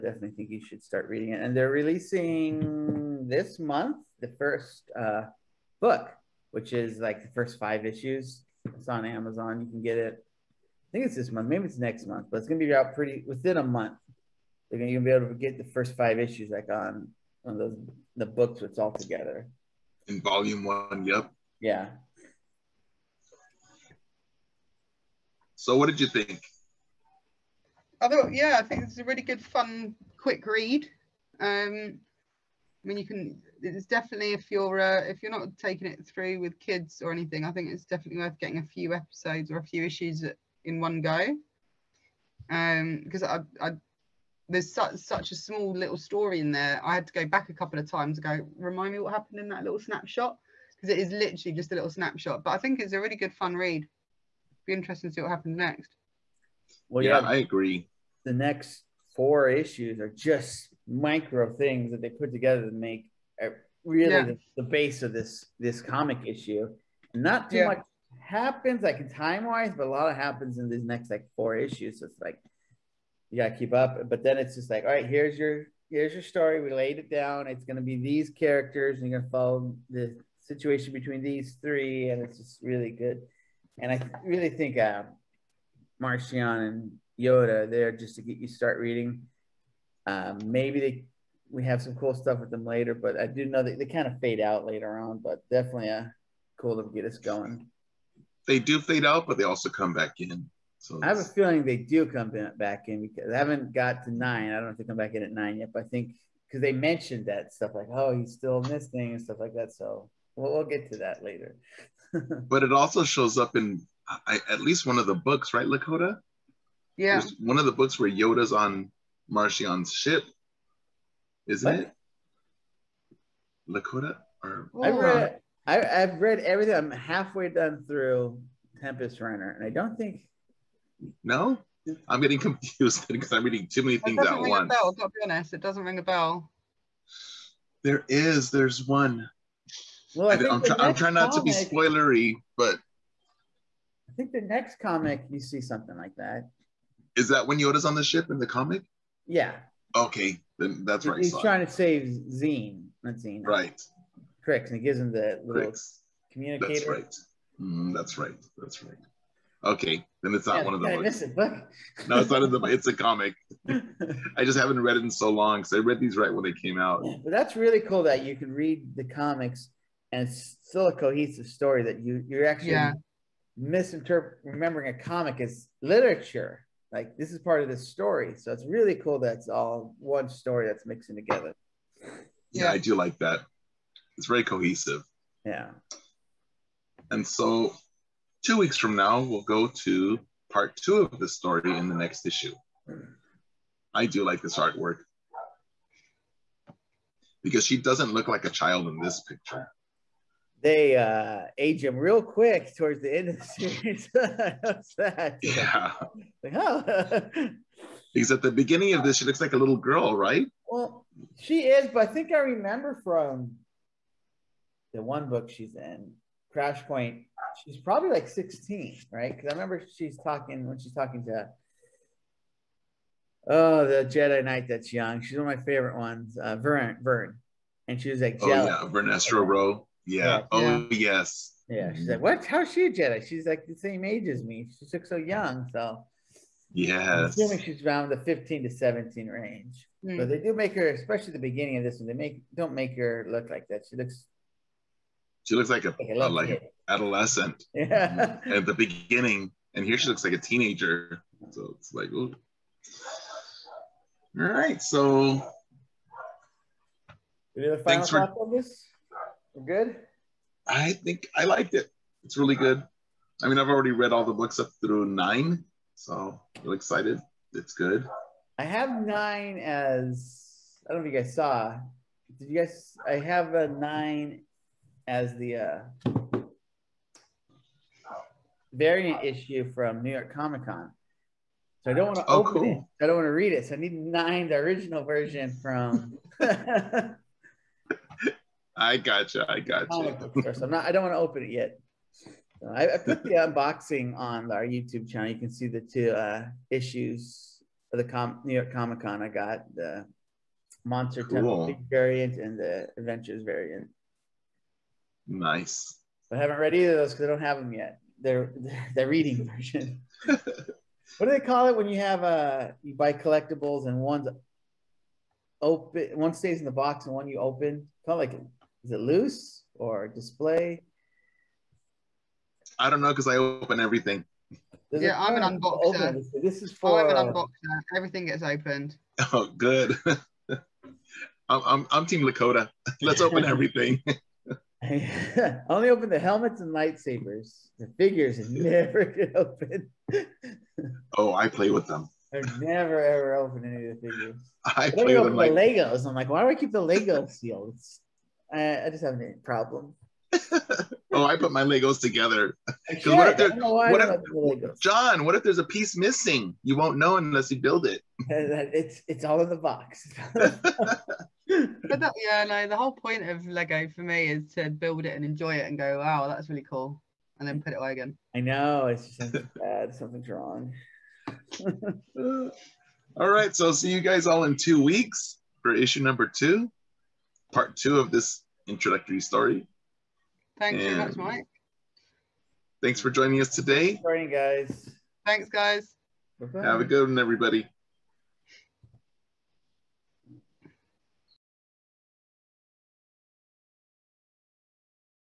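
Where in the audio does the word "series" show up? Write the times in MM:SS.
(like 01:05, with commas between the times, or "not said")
03:23.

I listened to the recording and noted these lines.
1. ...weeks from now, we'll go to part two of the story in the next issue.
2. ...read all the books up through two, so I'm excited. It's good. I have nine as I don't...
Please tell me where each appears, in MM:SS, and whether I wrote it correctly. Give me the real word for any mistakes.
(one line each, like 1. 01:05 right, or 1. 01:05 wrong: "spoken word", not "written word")
1. 03:08 right
2. 04:23 wrong: "nine", not "two".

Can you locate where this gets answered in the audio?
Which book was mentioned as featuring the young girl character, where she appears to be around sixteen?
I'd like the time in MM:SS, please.
03:36.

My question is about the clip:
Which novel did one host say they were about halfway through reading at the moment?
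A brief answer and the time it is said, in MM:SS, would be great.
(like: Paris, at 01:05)
Tempest Runner, at 02:08.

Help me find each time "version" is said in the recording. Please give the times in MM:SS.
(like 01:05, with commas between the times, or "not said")
04:45, 05:09.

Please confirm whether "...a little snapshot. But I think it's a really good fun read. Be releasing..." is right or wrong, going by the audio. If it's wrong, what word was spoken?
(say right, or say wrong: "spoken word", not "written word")
wrong: "interesting", not "releasing".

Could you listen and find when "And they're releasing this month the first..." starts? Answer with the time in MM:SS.
00:01.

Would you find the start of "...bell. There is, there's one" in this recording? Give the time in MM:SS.
02:16.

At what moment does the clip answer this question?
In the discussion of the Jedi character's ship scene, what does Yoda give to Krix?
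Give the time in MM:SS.
02:36.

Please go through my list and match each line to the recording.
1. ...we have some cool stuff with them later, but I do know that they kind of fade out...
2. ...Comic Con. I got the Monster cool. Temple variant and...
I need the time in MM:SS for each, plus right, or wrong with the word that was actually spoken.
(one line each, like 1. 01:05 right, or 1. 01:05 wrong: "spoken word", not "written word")
1. 01:31 right
2. 04:58 right.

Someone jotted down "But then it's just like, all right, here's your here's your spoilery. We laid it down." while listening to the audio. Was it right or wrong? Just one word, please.
wrong.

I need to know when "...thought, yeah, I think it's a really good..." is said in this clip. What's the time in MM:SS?
00:28.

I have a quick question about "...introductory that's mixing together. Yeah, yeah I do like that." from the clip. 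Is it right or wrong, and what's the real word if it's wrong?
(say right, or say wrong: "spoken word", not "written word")
wrong: "story", not "introductory".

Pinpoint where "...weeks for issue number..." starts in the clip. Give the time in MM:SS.
06:14.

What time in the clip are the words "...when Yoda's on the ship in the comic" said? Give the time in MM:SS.
02:27.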